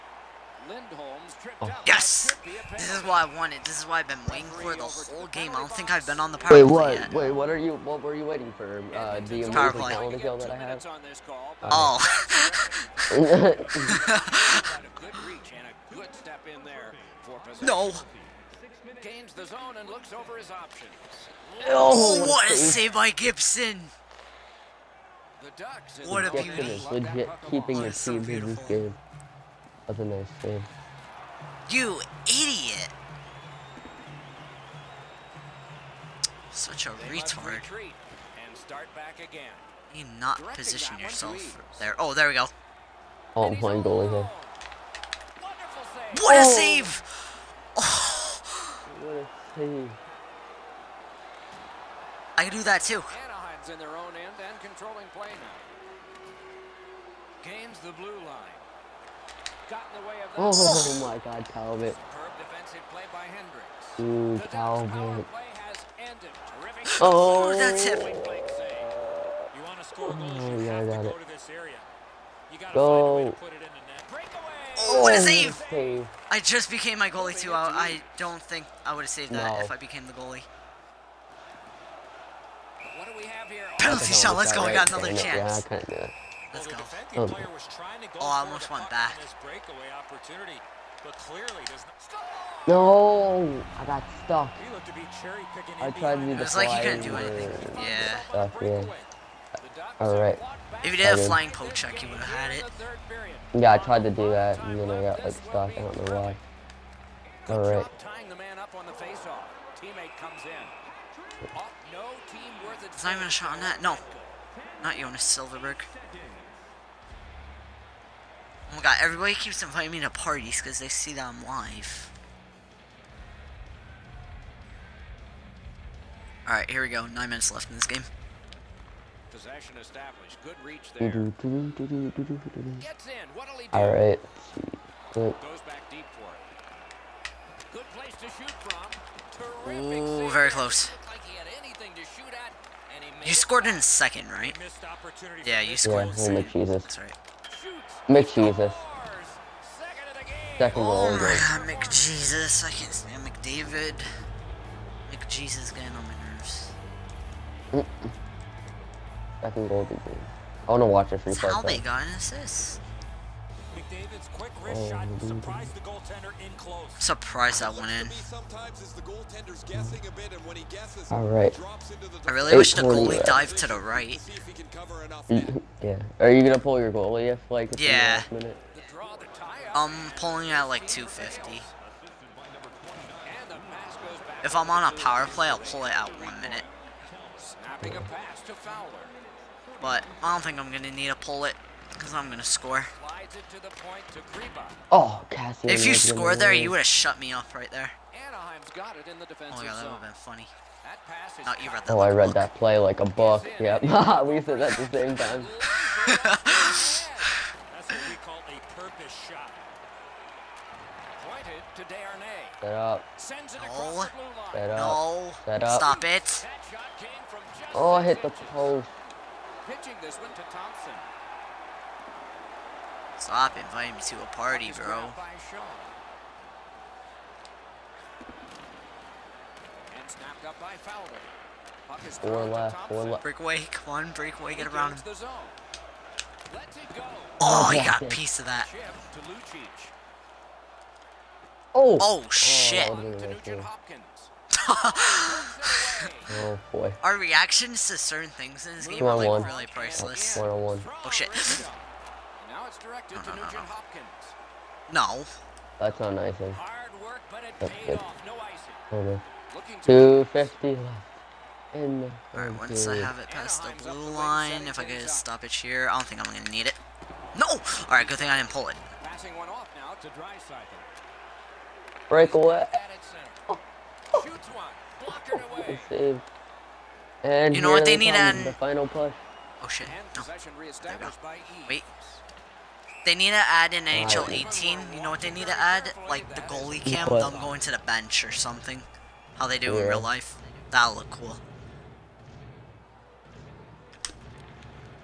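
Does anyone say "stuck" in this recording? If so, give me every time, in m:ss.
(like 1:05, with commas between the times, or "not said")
1:34, 1:45.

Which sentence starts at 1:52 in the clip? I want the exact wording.
There's not even a shot on that.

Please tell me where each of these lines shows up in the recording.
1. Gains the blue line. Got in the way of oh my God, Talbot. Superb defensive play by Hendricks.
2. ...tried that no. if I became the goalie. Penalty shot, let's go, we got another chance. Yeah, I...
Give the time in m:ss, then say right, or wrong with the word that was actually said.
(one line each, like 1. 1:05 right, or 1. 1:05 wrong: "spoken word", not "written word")
1. 0:57 right
2. 1:19 wrong: "saved", not "tried".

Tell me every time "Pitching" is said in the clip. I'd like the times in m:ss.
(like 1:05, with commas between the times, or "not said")
3:39.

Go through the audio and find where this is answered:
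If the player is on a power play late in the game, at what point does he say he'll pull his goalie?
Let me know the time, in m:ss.
3:06.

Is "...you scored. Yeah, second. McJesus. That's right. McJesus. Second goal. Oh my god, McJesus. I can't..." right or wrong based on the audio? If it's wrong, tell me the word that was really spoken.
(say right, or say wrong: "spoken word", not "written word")
right.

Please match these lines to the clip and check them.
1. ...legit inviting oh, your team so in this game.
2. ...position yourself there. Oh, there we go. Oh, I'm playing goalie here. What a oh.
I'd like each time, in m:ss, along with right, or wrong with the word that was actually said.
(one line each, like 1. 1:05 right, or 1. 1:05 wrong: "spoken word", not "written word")
1. 0:26 wrong: "keeping", not "inviting"
2. 0:40 right.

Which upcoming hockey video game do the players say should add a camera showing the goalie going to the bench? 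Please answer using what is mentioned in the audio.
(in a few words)
NHL 18.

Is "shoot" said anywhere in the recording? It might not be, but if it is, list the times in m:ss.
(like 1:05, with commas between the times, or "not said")
2:18, 4:34.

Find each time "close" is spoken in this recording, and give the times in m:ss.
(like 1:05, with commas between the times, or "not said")
2:20, 2:46.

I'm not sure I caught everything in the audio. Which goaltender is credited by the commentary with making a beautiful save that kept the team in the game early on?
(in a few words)
Gibson.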